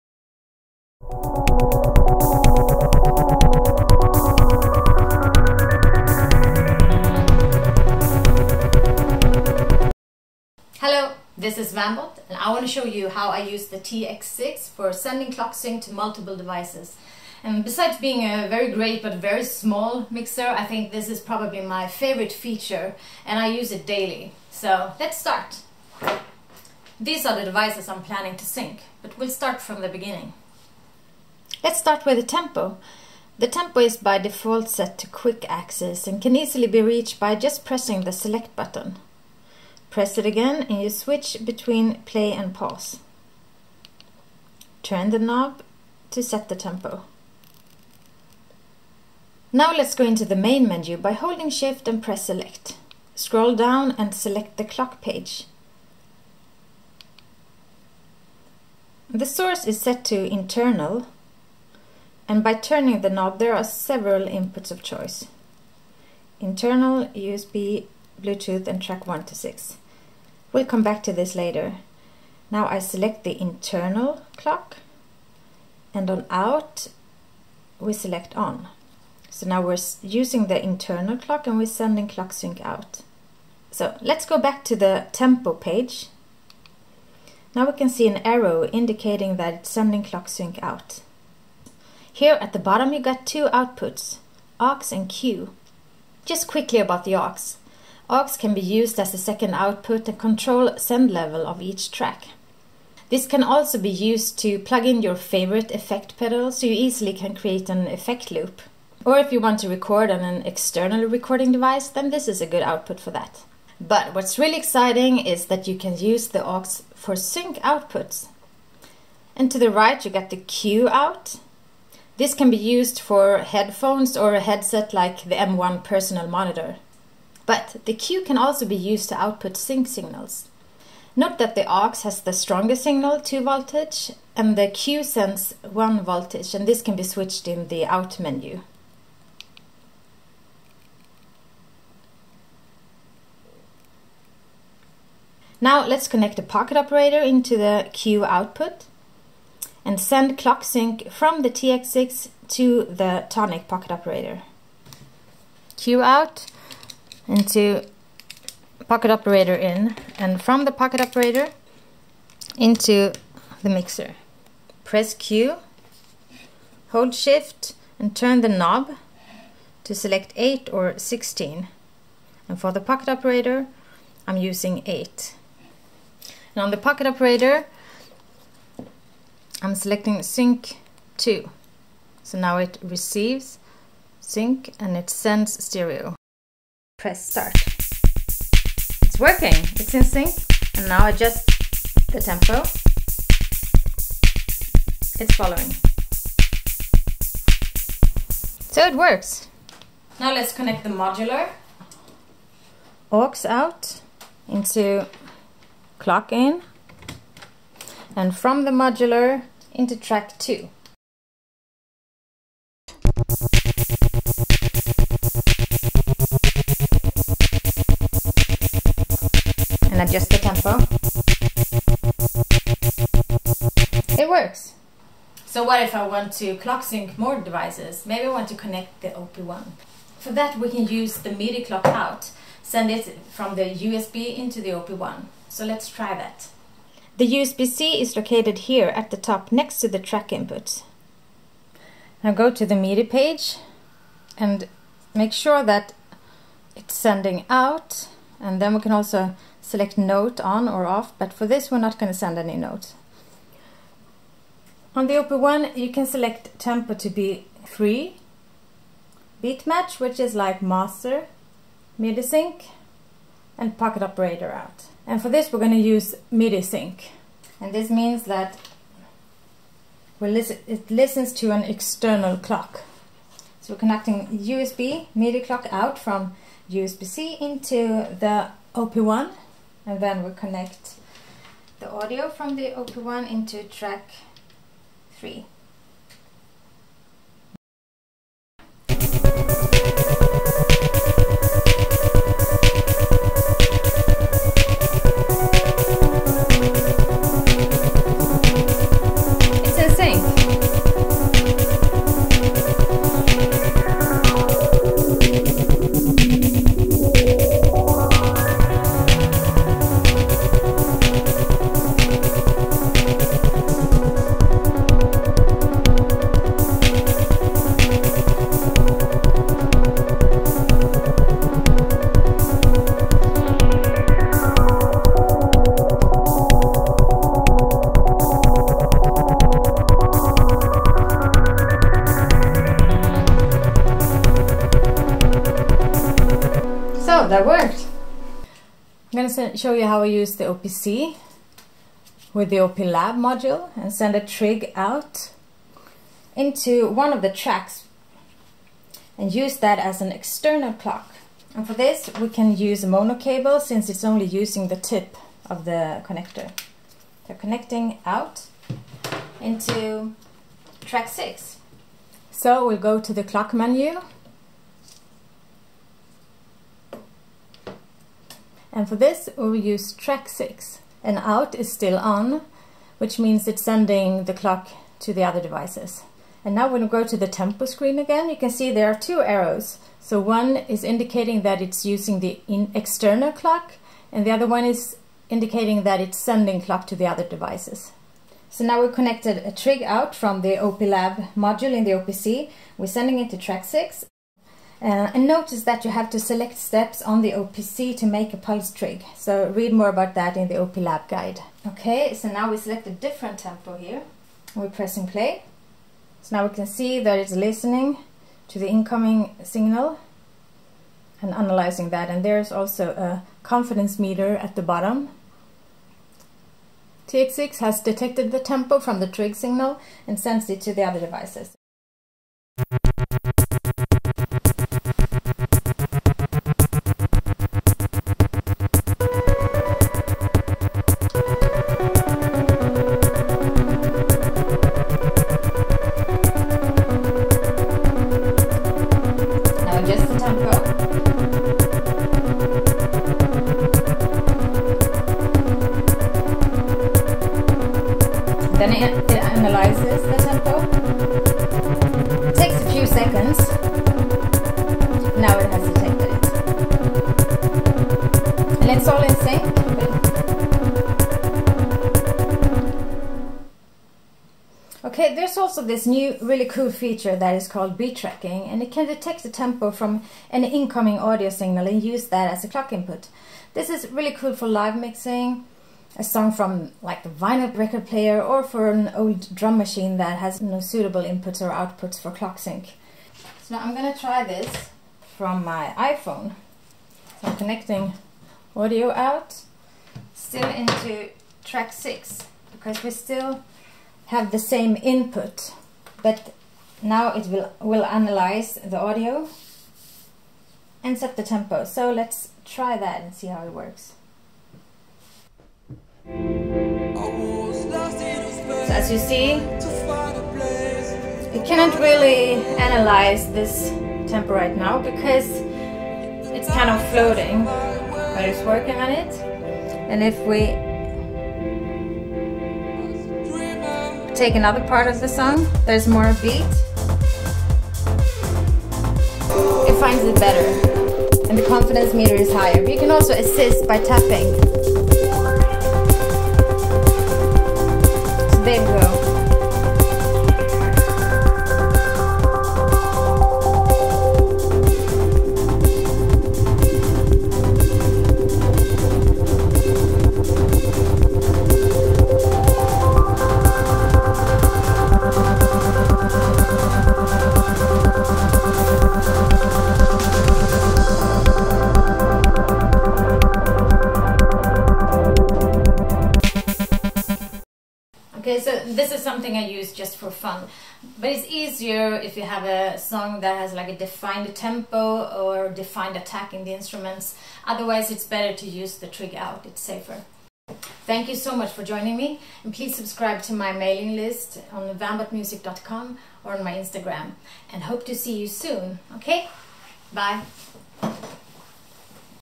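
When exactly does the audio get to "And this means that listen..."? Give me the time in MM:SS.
04:27.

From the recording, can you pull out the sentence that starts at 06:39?
So read more about that in the OP Lab guide.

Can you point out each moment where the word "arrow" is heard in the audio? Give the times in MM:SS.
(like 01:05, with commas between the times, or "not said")
01:28, 06:19.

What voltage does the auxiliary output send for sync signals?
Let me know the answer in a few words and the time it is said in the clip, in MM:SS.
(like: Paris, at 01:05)
2 volts, at 02:13.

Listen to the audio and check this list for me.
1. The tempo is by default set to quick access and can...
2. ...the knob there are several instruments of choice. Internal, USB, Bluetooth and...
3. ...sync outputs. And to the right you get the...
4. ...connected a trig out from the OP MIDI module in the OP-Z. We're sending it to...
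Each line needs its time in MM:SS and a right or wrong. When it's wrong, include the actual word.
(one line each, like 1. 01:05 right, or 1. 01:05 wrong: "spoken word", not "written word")
1. 00:33 right
2. 01:03 wrong: "inputs", not "instruments"
3. 01:57 right
4. 06:28 wrong: "Lab", not "MIDI".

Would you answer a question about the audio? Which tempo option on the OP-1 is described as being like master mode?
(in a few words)
Beat match.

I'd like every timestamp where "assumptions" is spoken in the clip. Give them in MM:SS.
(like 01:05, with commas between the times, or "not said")
not said.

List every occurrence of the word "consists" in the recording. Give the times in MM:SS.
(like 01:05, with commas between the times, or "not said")
not said.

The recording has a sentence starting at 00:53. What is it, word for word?
Scroll down and select the clock page.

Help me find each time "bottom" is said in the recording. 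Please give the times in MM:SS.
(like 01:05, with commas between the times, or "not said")
01:32, 06:54.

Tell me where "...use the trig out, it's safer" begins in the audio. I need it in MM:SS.
09:38.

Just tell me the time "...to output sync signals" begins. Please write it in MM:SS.
02:09.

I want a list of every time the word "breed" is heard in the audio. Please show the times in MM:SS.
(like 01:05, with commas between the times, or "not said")
not said.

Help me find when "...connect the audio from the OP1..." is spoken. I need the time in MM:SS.
04:40.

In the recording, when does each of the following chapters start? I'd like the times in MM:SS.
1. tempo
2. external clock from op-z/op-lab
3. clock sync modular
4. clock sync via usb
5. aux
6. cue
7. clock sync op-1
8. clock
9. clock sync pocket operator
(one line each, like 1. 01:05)
1. 00:30
2. 05:39
3. 03:20
4. 03:57
5. 01:37
6. 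02:09
7. 04:13
8. 00:50
9. 02:25.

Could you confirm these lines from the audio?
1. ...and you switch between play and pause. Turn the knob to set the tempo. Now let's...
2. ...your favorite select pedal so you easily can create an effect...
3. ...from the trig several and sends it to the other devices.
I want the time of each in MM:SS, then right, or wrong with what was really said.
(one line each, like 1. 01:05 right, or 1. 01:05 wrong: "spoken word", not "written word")
1. 00:40 right
2. 01:45 wrong: "effect", not "select"
3. 06:58 wrong: "signal", not "several".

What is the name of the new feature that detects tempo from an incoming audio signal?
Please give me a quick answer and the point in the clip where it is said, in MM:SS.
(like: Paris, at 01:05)
Beat tracking, at 07:47.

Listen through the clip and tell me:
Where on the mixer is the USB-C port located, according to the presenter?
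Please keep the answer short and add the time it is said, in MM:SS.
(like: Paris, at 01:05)
At the top, at 03:58.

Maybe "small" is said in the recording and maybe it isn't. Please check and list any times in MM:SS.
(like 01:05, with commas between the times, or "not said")
00:19.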